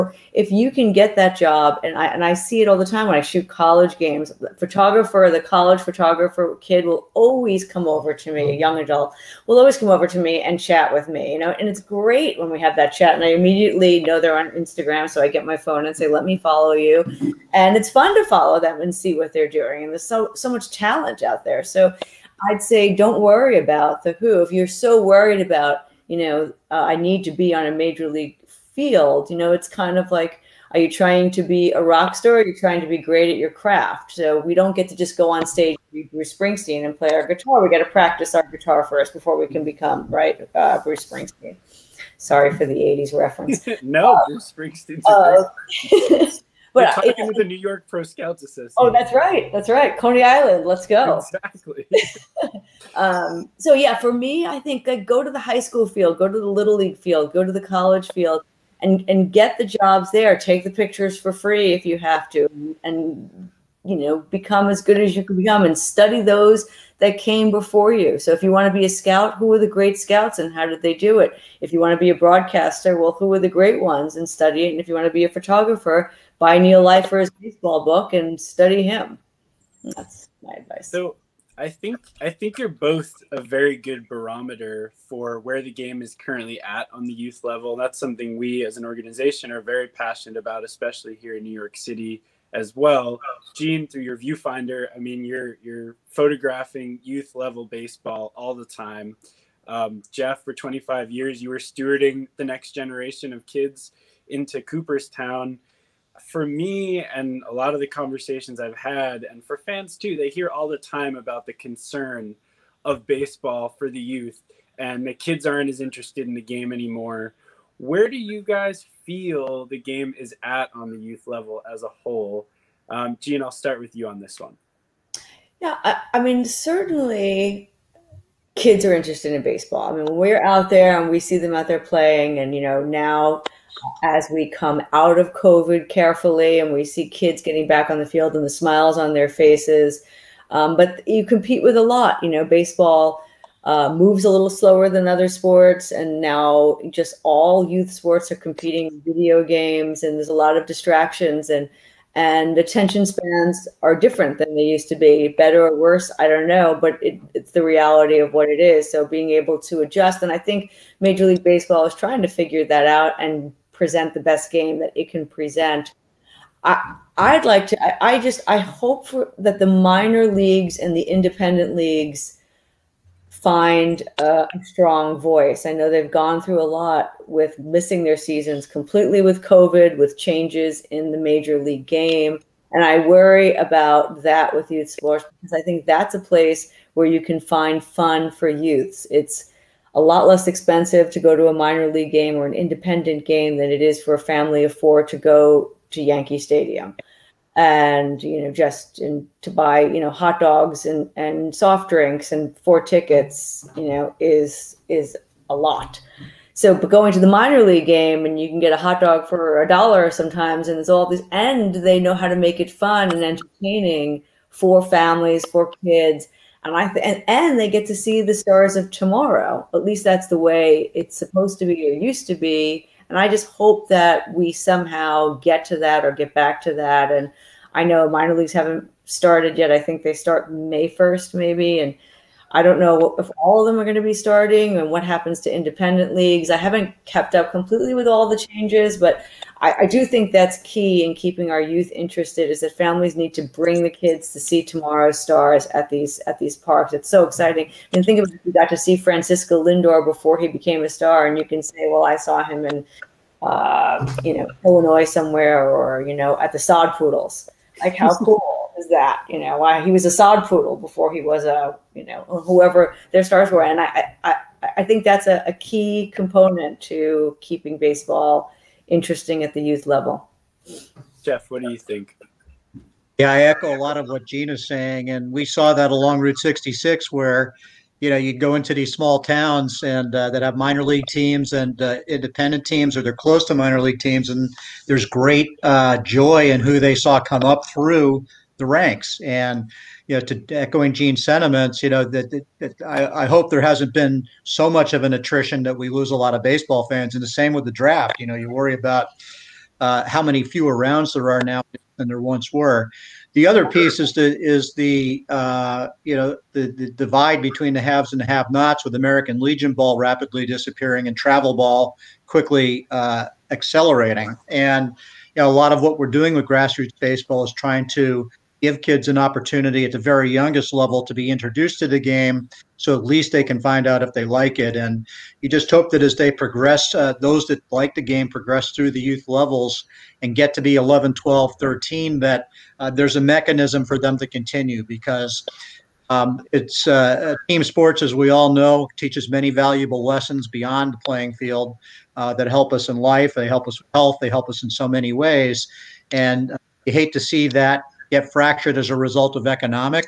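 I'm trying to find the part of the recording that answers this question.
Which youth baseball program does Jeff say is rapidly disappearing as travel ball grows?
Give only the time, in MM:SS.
05:08.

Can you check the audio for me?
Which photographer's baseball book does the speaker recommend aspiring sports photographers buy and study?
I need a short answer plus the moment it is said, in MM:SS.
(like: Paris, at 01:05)
Neil Leifer, at 01:16.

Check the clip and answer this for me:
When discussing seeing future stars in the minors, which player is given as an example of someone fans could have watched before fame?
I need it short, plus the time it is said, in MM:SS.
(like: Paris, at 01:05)
Francisco Lindor, at 04:08.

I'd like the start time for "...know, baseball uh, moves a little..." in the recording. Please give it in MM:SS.
02:22.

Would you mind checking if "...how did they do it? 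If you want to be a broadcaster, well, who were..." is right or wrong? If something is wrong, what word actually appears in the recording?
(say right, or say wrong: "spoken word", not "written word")
right.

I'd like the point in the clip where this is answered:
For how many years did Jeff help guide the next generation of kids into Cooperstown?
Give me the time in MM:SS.
01:40.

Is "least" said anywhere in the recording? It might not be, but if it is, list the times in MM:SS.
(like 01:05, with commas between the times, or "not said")
03:39, 05:23.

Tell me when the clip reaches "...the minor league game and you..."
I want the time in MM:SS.
03:27.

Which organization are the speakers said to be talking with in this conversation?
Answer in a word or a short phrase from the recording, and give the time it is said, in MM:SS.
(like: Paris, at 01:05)
New York Pro Scouts Association, at 00:47.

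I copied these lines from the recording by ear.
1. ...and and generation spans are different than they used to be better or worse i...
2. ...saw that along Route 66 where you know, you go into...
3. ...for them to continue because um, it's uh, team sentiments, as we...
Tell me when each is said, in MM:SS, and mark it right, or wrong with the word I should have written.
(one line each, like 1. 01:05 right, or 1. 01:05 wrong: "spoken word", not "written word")
1. 02:31 wrong: "attention", not "generation"
2. 04:35 right
3. 05:33 wrong: "sports", not "sentiments".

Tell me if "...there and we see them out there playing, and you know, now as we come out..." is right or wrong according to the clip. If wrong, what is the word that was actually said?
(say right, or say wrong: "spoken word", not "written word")
right.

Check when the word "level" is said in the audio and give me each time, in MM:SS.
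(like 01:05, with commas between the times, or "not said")
01:27, 01:37, 02:01, 04:29, 05:20, 05:29.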